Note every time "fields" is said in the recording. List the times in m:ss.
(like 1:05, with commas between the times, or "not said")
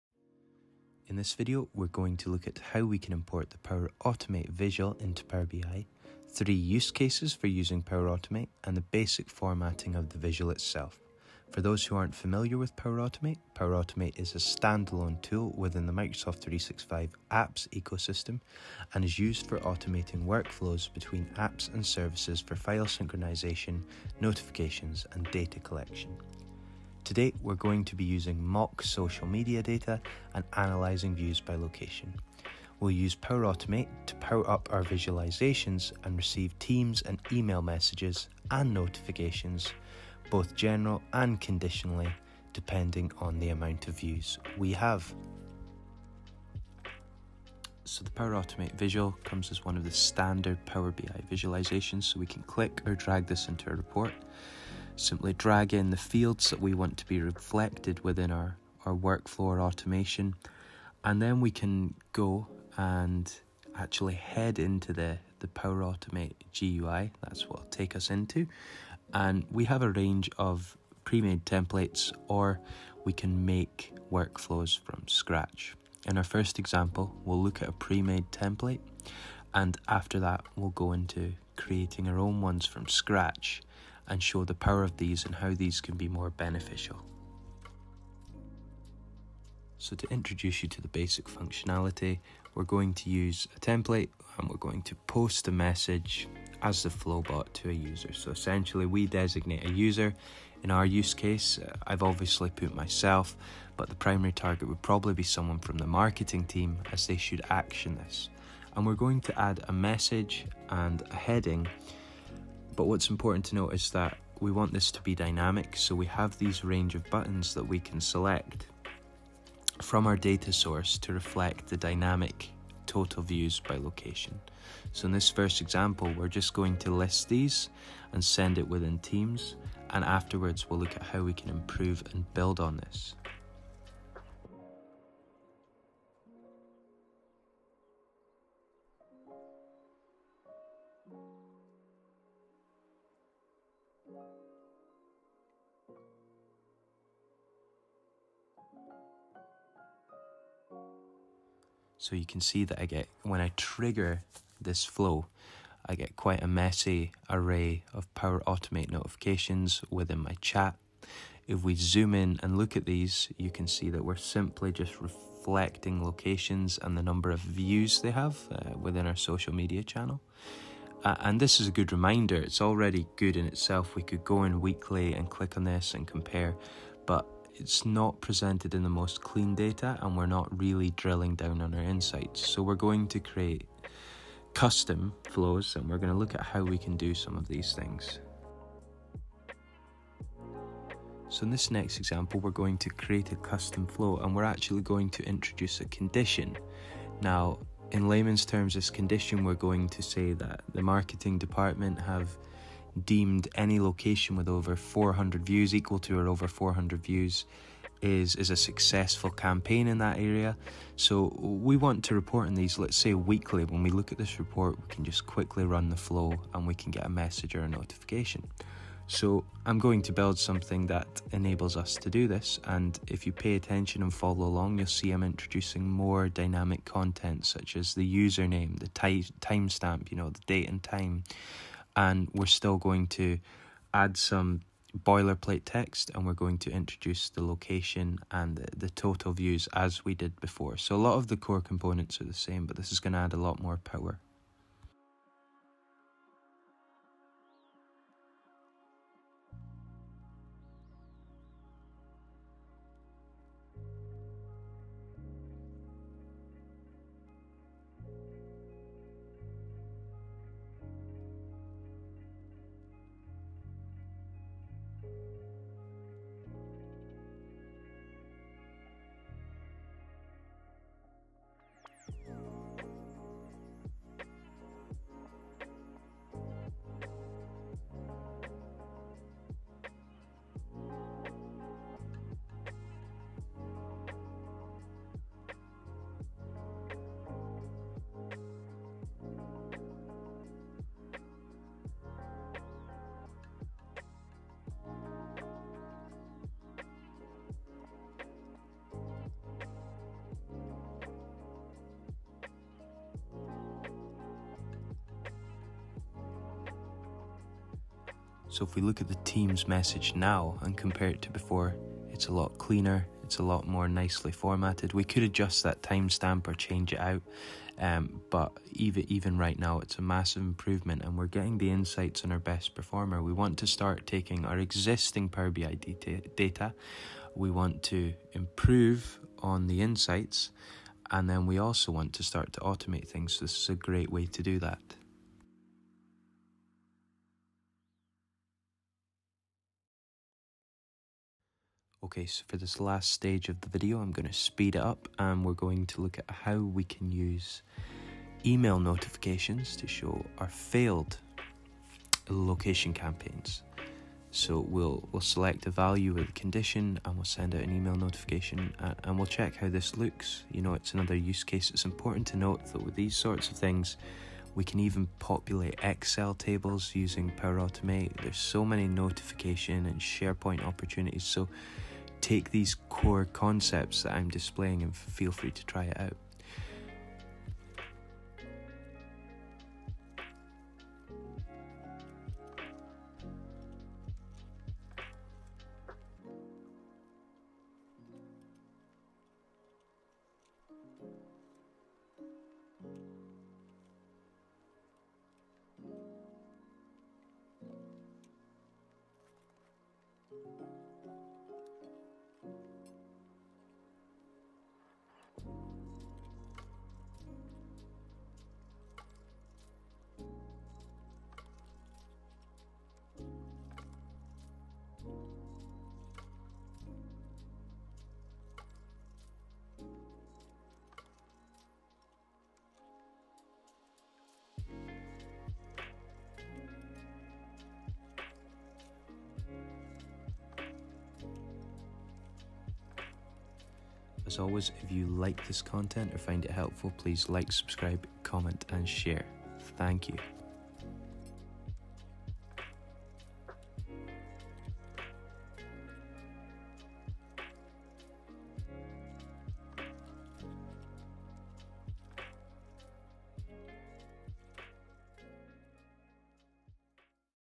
0:55.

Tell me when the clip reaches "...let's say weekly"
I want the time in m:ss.
3:32.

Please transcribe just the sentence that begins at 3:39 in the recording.
So I'm going to build something that enables us to do this.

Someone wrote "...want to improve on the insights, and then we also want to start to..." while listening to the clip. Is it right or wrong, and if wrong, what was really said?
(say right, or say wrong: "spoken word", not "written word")
right.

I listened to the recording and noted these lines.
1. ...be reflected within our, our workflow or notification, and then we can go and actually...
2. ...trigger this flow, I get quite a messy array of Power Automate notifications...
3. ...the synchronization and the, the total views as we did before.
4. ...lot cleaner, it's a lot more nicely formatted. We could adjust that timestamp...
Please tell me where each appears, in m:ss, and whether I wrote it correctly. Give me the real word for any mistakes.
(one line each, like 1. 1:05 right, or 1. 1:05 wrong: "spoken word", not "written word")
1. 0:57 wrong: "automation", not "notification"
2. 2:33 right
3. 3:57 wrong: "location", not "synchronization"
4. 5:12 right.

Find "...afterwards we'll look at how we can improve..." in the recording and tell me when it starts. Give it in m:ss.
2:10.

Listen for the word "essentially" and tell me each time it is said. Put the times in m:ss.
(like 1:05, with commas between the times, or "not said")
1:38.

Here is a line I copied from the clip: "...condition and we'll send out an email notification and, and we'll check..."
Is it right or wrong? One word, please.
right.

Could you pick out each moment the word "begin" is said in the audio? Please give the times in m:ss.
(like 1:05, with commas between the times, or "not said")
not said.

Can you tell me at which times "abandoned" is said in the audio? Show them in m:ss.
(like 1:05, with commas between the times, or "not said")
not said.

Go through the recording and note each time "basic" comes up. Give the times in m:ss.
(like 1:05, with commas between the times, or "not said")
0:08, 1:30.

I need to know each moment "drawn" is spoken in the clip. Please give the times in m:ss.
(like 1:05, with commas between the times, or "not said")
not said.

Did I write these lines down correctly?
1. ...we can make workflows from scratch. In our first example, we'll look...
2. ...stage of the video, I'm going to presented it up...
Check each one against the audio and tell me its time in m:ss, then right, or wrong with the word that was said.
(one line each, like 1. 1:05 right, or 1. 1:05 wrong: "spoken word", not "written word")
1. 1:13 right
2. 5:43 wrong: "speed", not "presented".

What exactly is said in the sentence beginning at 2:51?
Uh, and this is a good reminder, it's already good in itself.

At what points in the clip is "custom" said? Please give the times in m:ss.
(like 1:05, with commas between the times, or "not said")
3:04, 3:13.